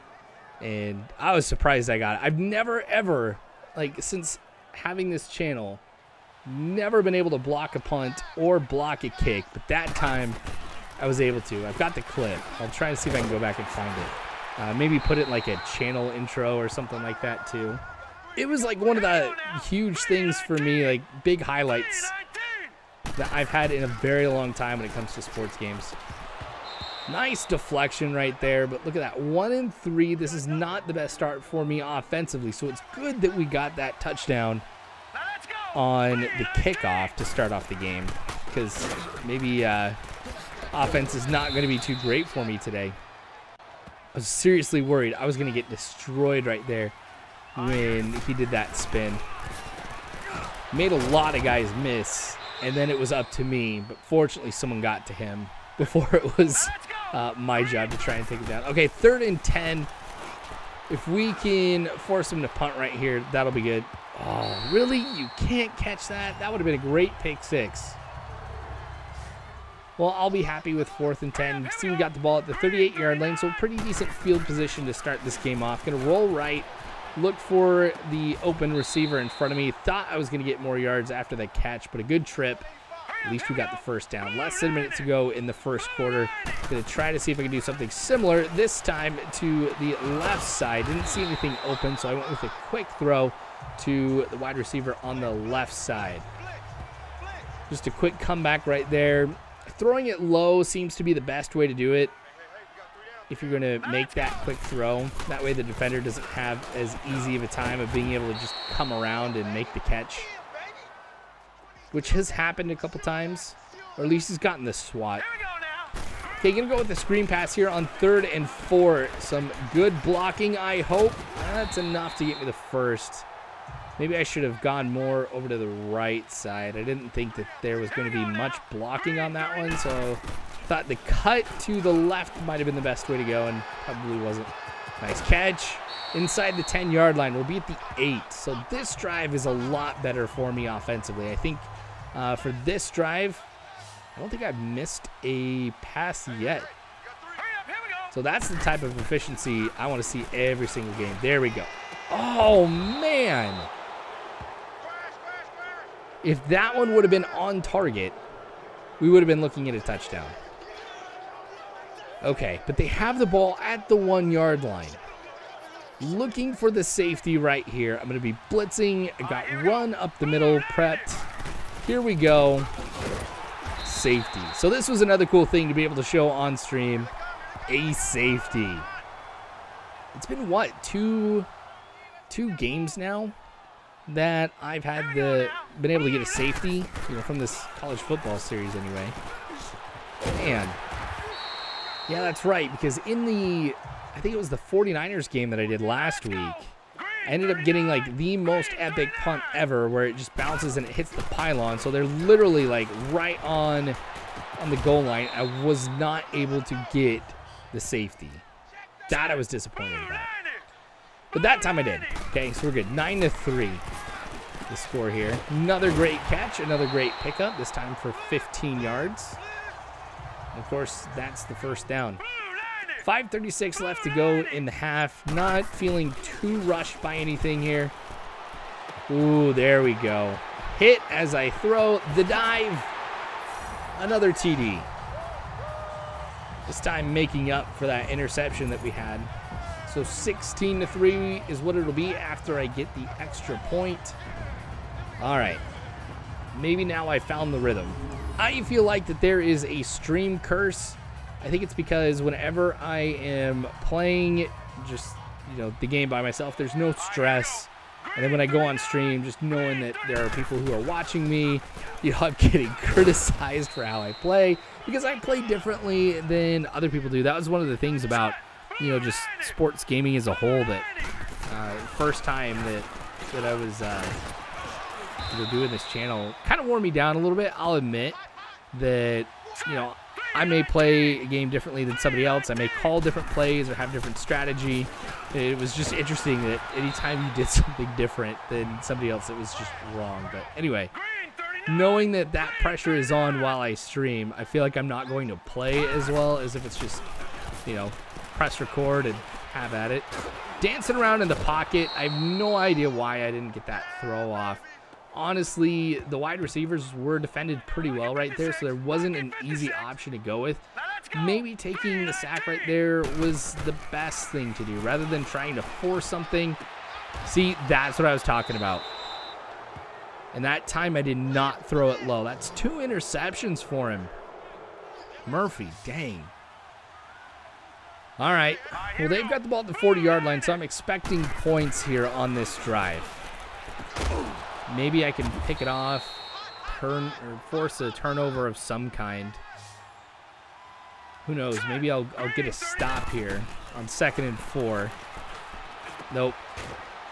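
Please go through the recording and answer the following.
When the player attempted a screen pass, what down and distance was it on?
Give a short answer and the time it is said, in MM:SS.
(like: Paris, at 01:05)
third and four, at 01:57.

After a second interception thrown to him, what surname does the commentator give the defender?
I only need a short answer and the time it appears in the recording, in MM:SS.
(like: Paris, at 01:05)
Murphy, at 05:25.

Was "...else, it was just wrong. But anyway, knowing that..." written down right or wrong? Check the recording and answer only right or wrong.
right.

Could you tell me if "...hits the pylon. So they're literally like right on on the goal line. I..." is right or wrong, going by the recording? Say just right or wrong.
right.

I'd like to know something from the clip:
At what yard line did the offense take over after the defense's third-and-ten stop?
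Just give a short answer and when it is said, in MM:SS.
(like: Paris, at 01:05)
38, at 01:12.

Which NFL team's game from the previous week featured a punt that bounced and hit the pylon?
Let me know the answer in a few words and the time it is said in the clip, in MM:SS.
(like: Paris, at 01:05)
49ers, at 03:14.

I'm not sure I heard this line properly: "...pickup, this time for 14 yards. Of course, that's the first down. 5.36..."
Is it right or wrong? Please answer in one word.
wrong.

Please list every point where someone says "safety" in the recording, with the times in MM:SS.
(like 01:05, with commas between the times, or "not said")
02:46, 02:53, 02:57, 03:06, 03:27.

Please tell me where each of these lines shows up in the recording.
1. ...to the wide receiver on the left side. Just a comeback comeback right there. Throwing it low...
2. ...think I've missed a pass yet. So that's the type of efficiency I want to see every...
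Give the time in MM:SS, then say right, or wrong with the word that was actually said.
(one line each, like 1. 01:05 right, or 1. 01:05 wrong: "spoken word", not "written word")
1. 01:33 wrong: "quick", not "comeback"
2. 02:24 right.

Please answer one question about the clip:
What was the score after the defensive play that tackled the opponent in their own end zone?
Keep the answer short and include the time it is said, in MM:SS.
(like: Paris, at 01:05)
9 to 3, at 03:32.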